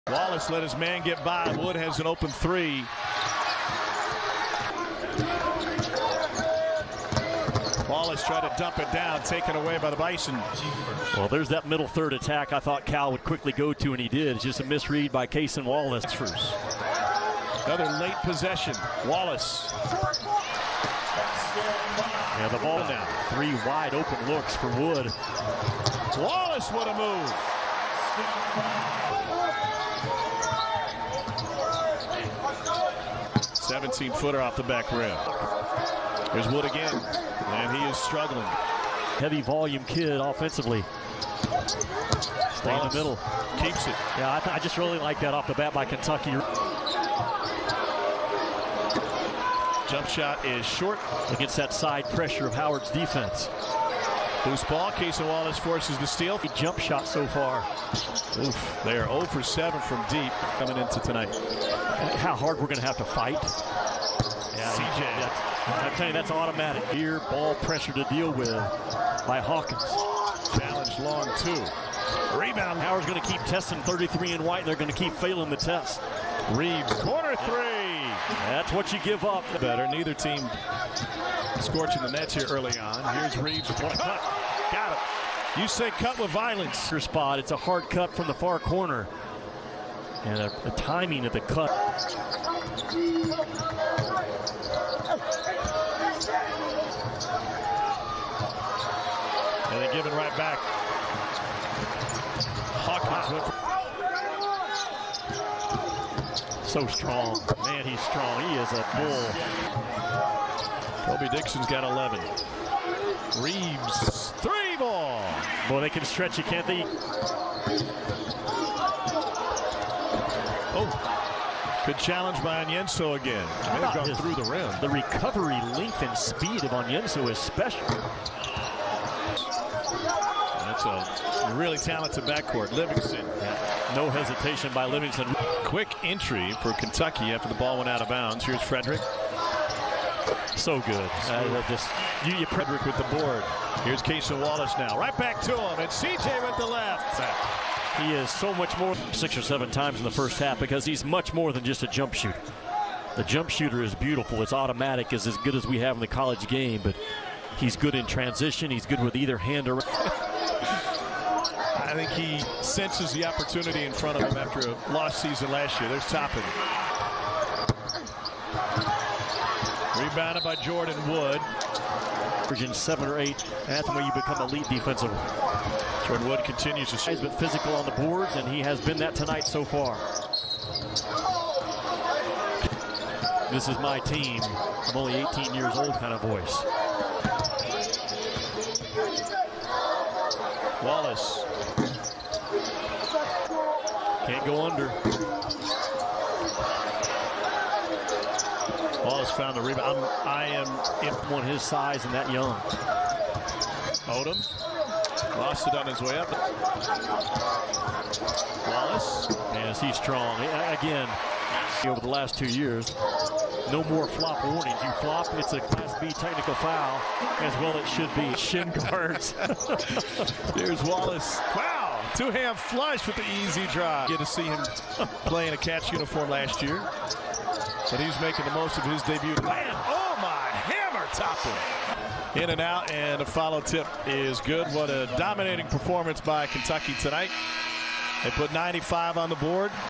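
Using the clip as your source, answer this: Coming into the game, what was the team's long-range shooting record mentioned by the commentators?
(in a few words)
0 for 7.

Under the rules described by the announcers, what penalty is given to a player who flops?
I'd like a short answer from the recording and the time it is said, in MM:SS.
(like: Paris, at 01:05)
Class B technical foul, at 03:35.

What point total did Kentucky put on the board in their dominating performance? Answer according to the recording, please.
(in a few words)
95.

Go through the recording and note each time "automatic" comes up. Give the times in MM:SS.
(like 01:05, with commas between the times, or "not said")
01:06, 02:34.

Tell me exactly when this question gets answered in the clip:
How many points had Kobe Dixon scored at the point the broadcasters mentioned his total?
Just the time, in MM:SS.
01:51.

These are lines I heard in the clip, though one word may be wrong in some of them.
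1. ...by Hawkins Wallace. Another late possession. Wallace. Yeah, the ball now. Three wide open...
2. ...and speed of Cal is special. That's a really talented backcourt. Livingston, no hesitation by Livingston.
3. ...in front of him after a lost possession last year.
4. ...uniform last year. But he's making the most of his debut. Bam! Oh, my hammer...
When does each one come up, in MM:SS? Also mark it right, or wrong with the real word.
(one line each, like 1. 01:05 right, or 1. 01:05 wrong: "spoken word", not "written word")
1. 00:15 wrong: "Cason", not "Hawkins"
2. 02:06 wrong: "Onyenso", not "Cal"
3. 02:43 wrong: "season", not "possession"
4. 03:45 right.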